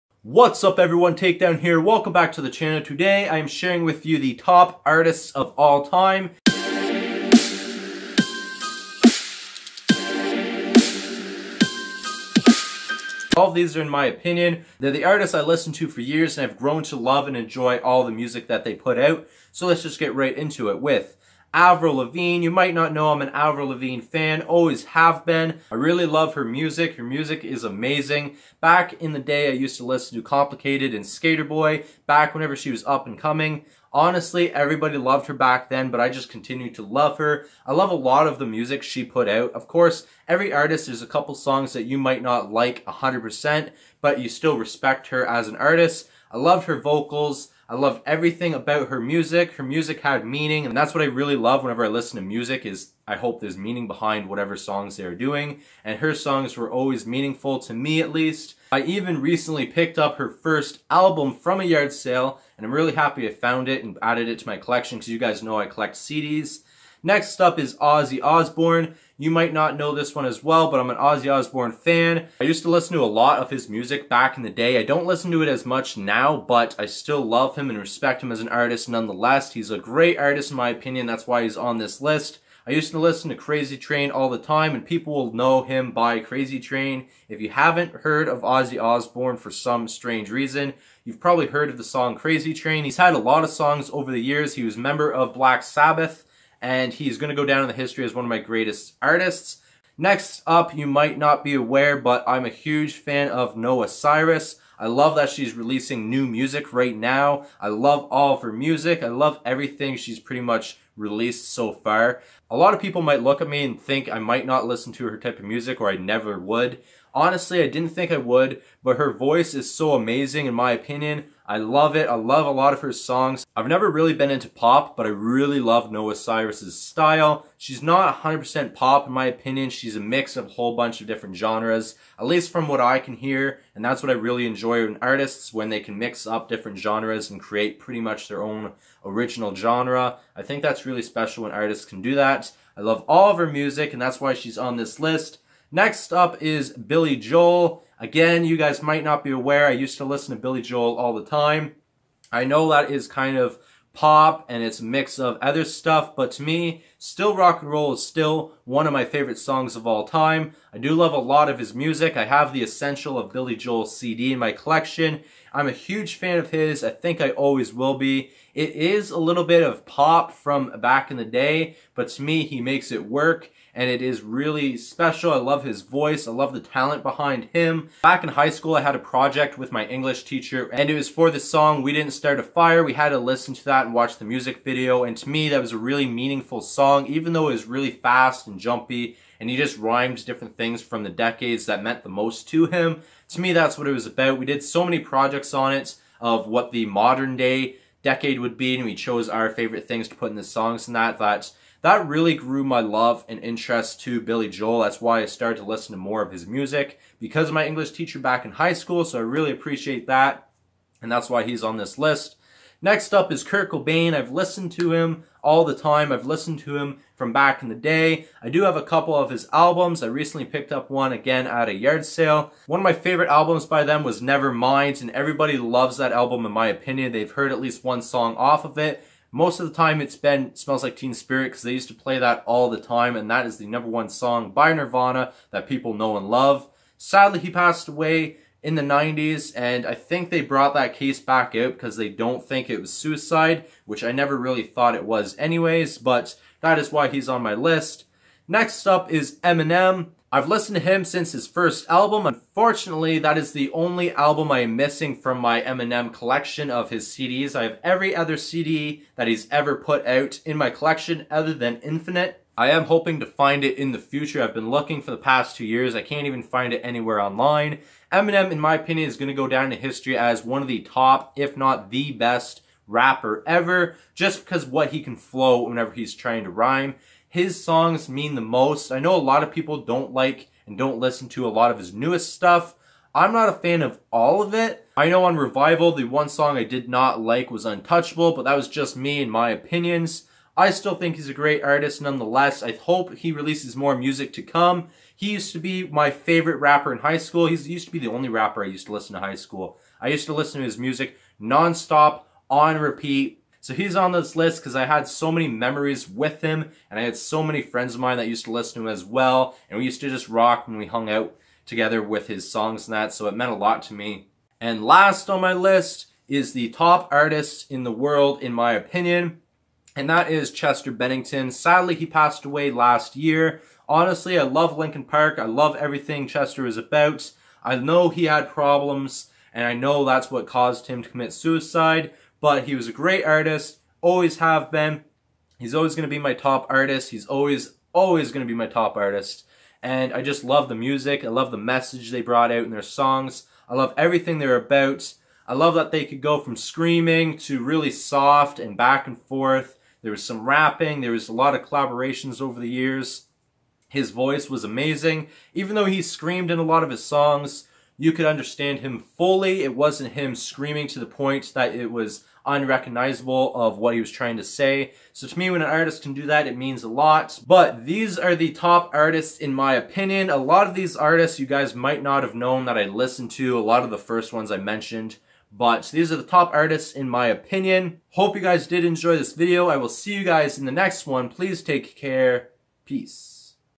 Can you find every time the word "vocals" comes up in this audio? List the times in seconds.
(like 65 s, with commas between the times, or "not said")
46 s.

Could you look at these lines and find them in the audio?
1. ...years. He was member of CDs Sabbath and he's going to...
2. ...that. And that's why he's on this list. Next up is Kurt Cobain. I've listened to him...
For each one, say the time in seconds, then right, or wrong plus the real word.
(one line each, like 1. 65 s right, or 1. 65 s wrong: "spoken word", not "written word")
1. 94 s wrong: "Black", not "CDs"
2. 210 s right.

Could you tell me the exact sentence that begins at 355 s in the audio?
Even though he screamed in a lot of his songs, you could understand him fully.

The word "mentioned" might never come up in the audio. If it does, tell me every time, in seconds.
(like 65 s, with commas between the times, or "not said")
374 s.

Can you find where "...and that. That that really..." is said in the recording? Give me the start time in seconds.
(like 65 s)
200 s.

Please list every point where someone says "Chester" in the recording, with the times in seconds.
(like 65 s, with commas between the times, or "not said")
320 s, 326 s.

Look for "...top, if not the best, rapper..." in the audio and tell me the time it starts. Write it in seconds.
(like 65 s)
270 s.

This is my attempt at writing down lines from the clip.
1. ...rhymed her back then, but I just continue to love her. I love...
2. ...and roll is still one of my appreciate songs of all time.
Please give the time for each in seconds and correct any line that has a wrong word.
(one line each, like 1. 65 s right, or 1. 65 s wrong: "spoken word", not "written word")
1. 34 s wrong: "loved", not "rhymed"
2. 157 s wrong: "favorite", not "appreciate".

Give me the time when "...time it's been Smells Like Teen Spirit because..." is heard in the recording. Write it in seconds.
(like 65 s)
229 s.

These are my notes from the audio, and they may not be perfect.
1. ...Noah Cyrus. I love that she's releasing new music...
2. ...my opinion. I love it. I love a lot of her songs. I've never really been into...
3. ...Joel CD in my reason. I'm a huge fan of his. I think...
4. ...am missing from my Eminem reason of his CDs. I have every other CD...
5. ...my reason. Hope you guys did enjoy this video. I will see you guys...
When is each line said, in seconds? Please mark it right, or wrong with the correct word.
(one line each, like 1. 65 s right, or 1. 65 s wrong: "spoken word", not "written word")
1. 103 s right
2. 120 s right
3. 163 s wrong: "collection", not "reason"
4. 254 s wrong: "collection", not "reason"
5. 377 s wrong: "opinion", not "reason".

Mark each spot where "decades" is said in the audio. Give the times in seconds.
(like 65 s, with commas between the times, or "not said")
191 s, 198 s.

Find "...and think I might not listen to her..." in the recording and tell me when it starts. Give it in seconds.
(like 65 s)
113 s.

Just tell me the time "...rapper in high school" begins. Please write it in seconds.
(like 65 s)
296 s.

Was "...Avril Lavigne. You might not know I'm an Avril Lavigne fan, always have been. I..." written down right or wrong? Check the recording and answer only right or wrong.
right.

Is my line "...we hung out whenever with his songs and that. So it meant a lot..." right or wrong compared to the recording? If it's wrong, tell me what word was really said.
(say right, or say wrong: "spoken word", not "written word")
wrong: "together", not "whenever".